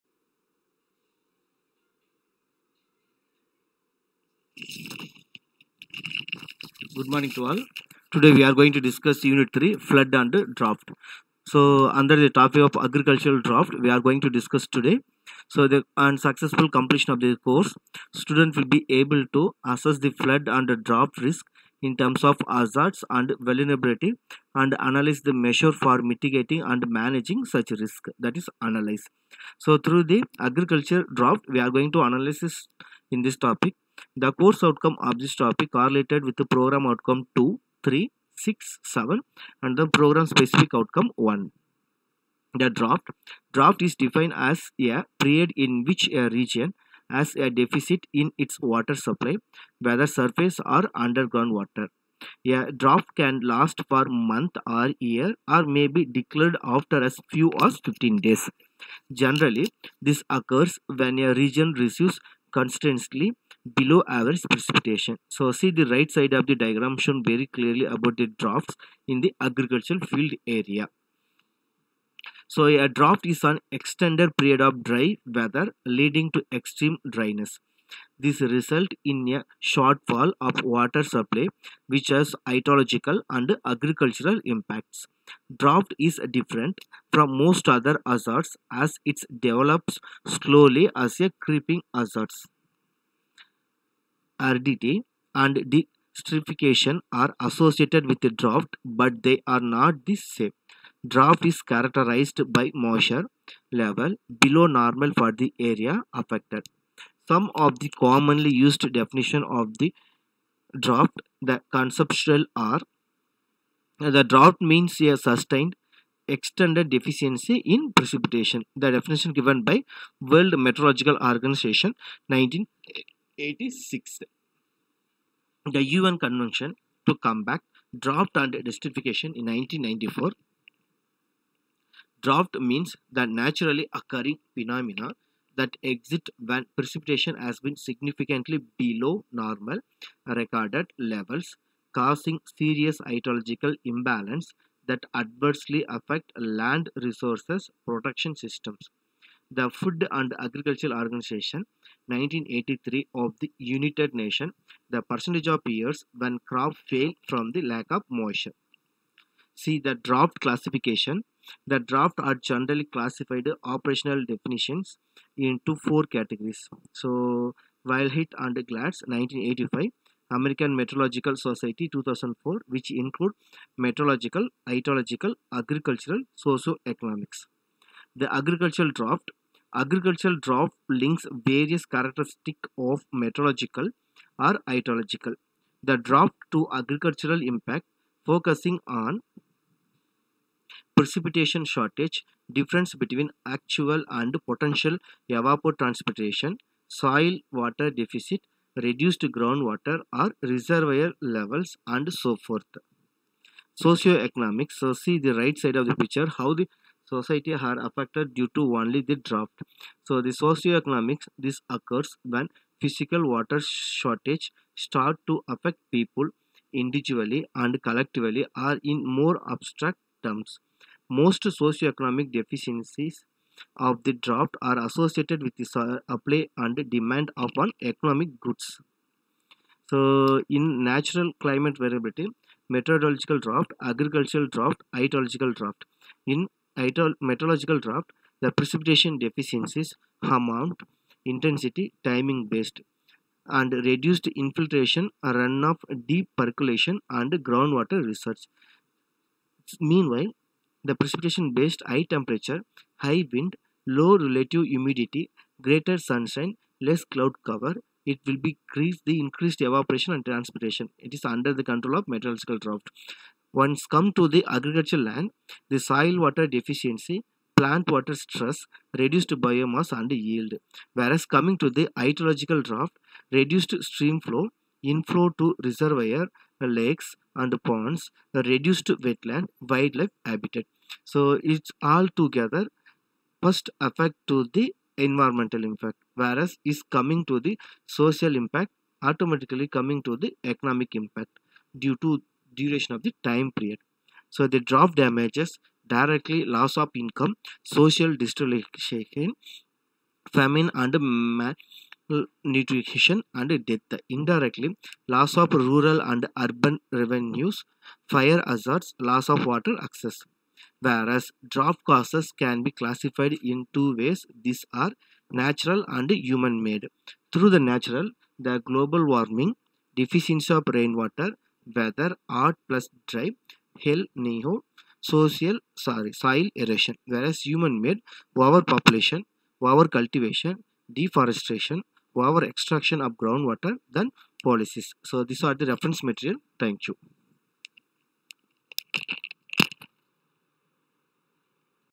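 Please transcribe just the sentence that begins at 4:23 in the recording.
Once come to the agricultural land, the soil water deficiency, plant water stress, reduced biomass and yield.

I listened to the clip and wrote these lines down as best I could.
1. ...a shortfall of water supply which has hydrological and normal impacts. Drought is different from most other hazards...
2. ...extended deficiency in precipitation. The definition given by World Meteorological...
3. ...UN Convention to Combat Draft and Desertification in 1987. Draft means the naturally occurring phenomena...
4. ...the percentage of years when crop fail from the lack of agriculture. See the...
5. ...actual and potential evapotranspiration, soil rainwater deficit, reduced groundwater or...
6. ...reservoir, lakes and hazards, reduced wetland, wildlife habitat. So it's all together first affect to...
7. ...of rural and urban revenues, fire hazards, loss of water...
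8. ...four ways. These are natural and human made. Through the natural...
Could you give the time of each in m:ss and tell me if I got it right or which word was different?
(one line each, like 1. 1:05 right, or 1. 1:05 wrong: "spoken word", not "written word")
1. 1:19 wrong: "agricultural", not "normal"
2. 1:56 right
3. 2:05 wrong: "1994", not "1987"
4. 2:34 wrong: "moisture", not "agriculture"
5. 3:13 wrong: "water", not "rainwater"
6. 4:35 wrong: "ponds", not "hazards"
7. 5:05 right
8. 5:13 wrong: "two", not "four".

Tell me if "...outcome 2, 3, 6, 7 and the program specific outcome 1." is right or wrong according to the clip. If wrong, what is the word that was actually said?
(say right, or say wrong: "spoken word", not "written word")
right.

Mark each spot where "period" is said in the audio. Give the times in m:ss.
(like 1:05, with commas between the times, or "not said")
0:45, 1:14, 4:53.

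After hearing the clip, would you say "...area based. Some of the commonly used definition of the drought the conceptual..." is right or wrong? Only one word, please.
wrong.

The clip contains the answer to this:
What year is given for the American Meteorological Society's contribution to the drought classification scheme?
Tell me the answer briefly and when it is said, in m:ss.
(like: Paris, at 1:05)
2004, at 2:51.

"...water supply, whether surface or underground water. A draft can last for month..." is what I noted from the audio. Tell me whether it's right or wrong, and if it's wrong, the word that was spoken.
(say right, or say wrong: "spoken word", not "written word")
right.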